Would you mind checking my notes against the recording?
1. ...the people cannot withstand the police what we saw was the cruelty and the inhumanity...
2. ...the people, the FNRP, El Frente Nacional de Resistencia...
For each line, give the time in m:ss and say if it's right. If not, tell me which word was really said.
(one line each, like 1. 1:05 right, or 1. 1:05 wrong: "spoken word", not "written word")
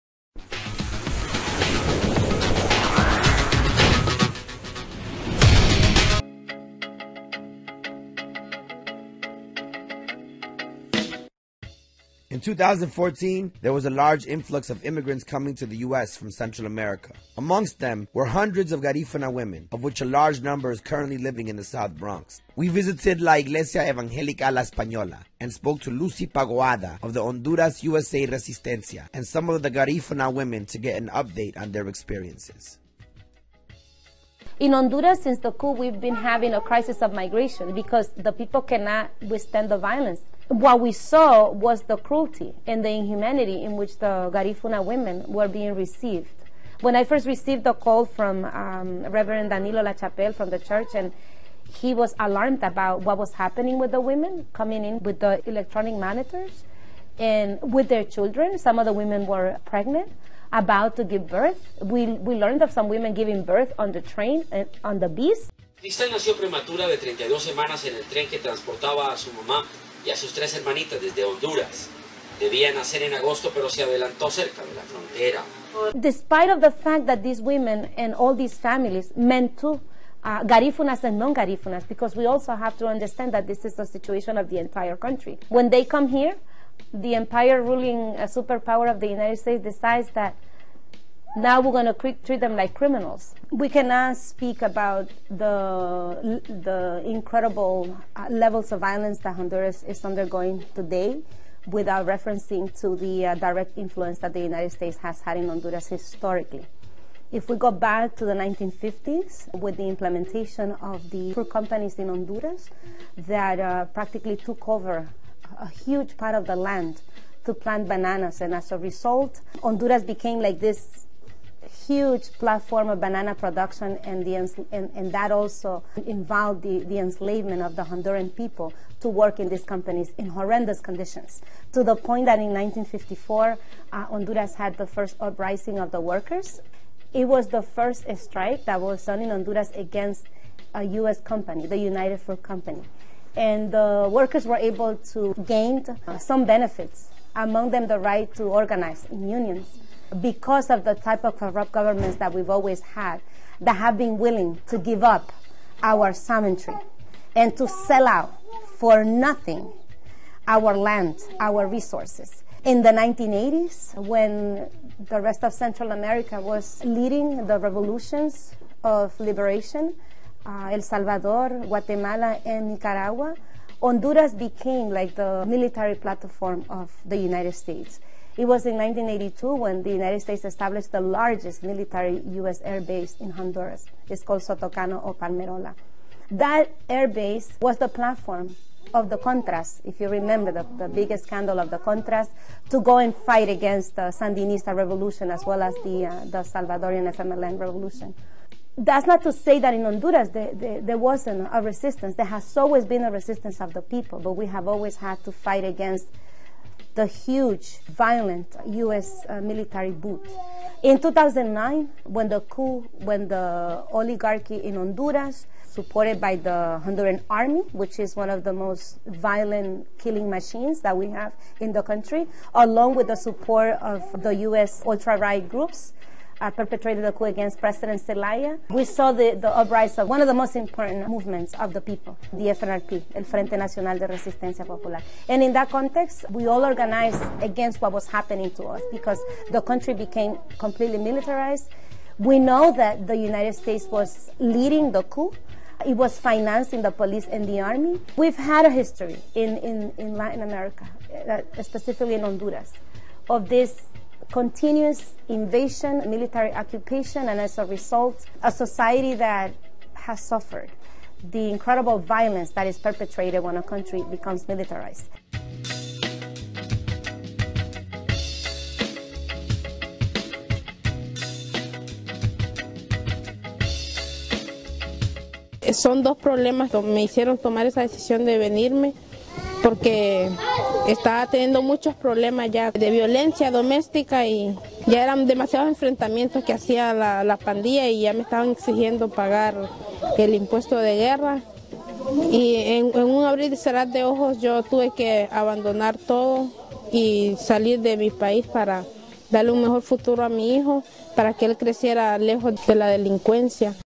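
1. 0:38 wrong: "violence", not "police"
2. 3:51 right.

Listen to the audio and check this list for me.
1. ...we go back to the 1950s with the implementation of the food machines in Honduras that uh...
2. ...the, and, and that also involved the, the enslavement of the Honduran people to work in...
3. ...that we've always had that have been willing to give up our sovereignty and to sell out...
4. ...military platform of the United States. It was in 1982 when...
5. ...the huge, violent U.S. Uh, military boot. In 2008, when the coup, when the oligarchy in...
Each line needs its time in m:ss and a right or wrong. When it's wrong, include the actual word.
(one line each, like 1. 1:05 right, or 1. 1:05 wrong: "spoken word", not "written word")
1. 1:47 wrong: "companies", not "machines"
2. 2:04 right
3. 2:32 right
4. 2:55 right
5. 3:26 wrong: "2009", not "2008".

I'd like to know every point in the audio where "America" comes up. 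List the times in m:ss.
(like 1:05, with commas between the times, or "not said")
0:16, 2:45, 4:10.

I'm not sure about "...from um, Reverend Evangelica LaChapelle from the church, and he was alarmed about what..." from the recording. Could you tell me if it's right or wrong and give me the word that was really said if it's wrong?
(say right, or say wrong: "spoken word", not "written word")
wrong: "Danilo", not "Evangelica".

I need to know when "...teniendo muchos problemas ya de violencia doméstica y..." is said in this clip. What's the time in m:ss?
4:41.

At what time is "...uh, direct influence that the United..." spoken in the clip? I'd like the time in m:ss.
1:43.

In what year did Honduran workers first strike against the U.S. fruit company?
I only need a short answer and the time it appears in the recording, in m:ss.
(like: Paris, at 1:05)
1954, at 2:12.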